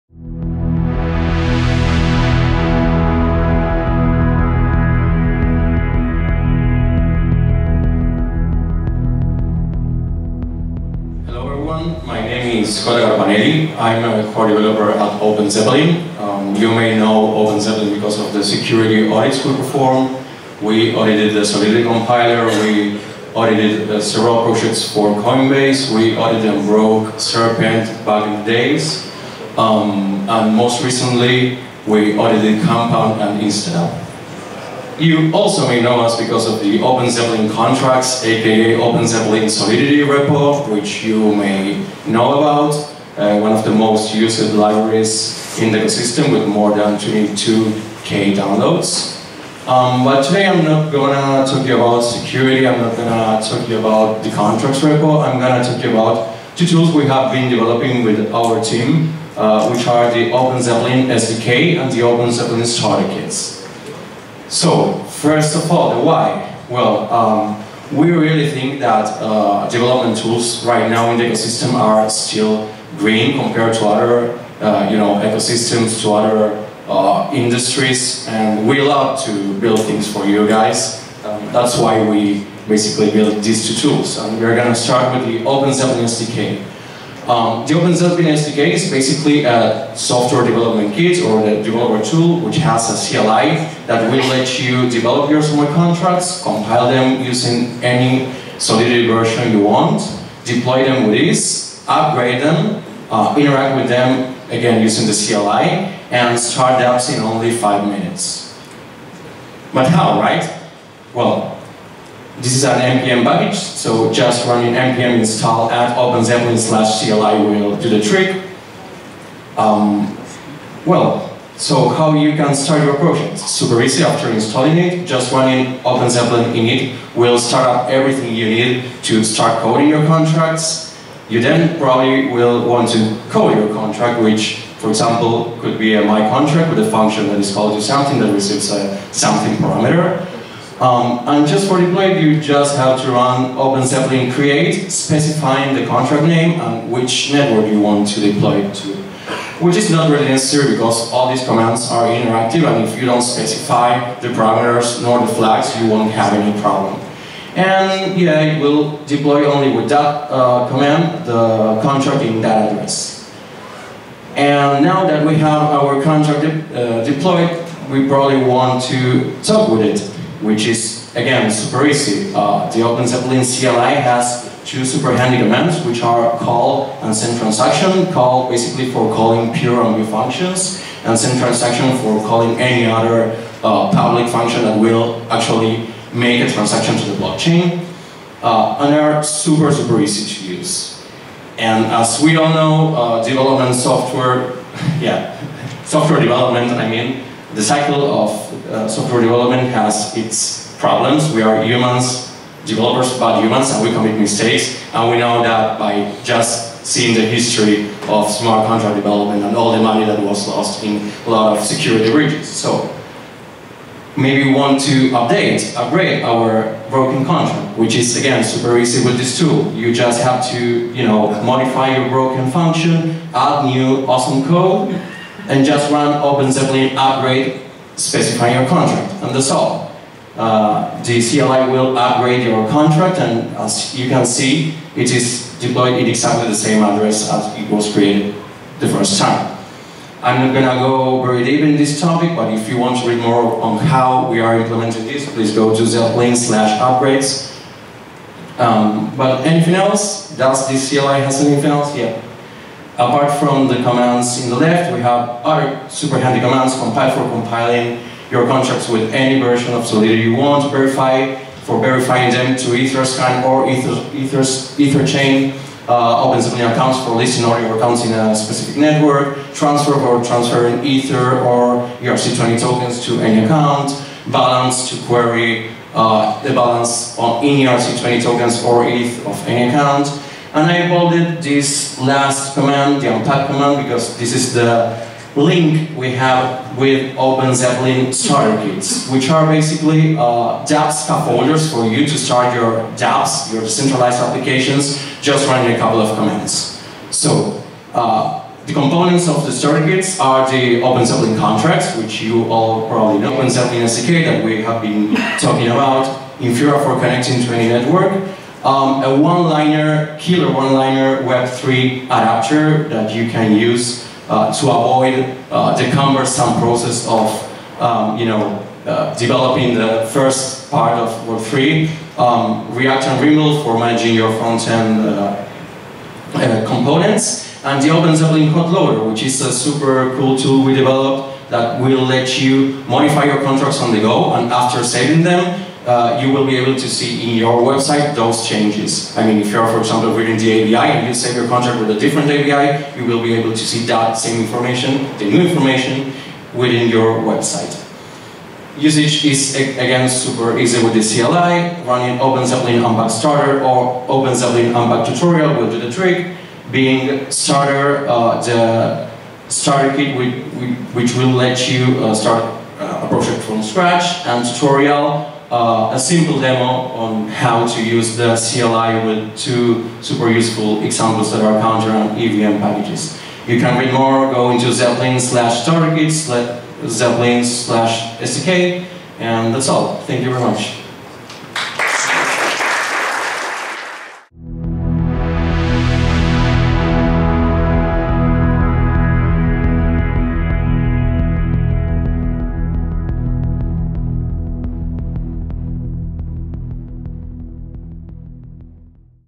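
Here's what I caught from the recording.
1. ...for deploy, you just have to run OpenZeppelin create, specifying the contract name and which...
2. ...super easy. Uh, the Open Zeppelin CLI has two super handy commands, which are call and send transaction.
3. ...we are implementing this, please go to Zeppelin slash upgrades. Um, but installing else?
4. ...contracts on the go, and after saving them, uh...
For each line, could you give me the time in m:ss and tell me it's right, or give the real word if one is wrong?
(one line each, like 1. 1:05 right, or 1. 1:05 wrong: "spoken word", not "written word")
1. 2:21 right
2. 2:51 right
3. 4:04 wrong: "anything", not "installing"
4. 5:33 right.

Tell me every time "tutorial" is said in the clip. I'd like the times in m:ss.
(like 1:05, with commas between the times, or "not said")
5:55, 6:04.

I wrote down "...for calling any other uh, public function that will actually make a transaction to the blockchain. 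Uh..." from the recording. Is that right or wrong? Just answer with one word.
right.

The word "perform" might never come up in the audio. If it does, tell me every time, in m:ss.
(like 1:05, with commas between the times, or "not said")
0:19.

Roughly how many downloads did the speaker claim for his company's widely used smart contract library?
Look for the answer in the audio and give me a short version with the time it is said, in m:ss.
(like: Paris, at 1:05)
22k, at 0:46.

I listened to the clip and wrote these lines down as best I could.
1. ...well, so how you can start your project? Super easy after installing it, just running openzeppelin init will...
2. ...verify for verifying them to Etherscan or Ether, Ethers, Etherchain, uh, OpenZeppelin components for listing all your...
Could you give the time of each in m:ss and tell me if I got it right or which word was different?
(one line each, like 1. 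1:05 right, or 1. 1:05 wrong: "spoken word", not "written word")
1. 2:00 right
2. 4:20 wrong: "accounts", not "components".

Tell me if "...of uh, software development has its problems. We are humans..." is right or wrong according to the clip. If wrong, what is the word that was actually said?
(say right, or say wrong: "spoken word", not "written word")
right.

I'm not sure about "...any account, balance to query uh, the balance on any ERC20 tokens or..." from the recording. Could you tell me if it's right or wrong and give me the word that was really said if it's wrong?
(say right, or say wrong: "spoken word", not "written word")
right.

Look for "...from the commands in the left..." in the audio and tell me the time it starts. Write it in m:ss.
4:13.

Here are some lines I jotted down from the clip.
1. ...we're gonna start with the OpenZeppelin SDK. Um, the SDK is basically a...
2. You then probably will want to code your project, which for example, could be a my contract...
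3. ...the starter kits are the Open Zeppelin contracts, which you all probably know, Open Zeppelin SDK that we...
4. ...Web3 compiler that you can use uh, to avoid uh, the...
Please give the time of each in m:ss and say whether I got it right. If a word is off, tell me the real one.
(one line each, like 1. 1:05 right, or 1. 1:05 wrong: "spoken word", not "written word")
1. 1:24 right
2. 2:11 wrong: "contract", not "project"
3. 4:59 right
4. 5:11 wrong: "adapter", not "compiler".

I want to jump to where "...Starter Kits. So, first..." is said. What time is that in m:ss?
1:02.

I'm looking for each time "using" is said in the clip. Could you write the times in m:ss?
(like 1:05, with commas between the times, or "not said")
1:37, 1:44.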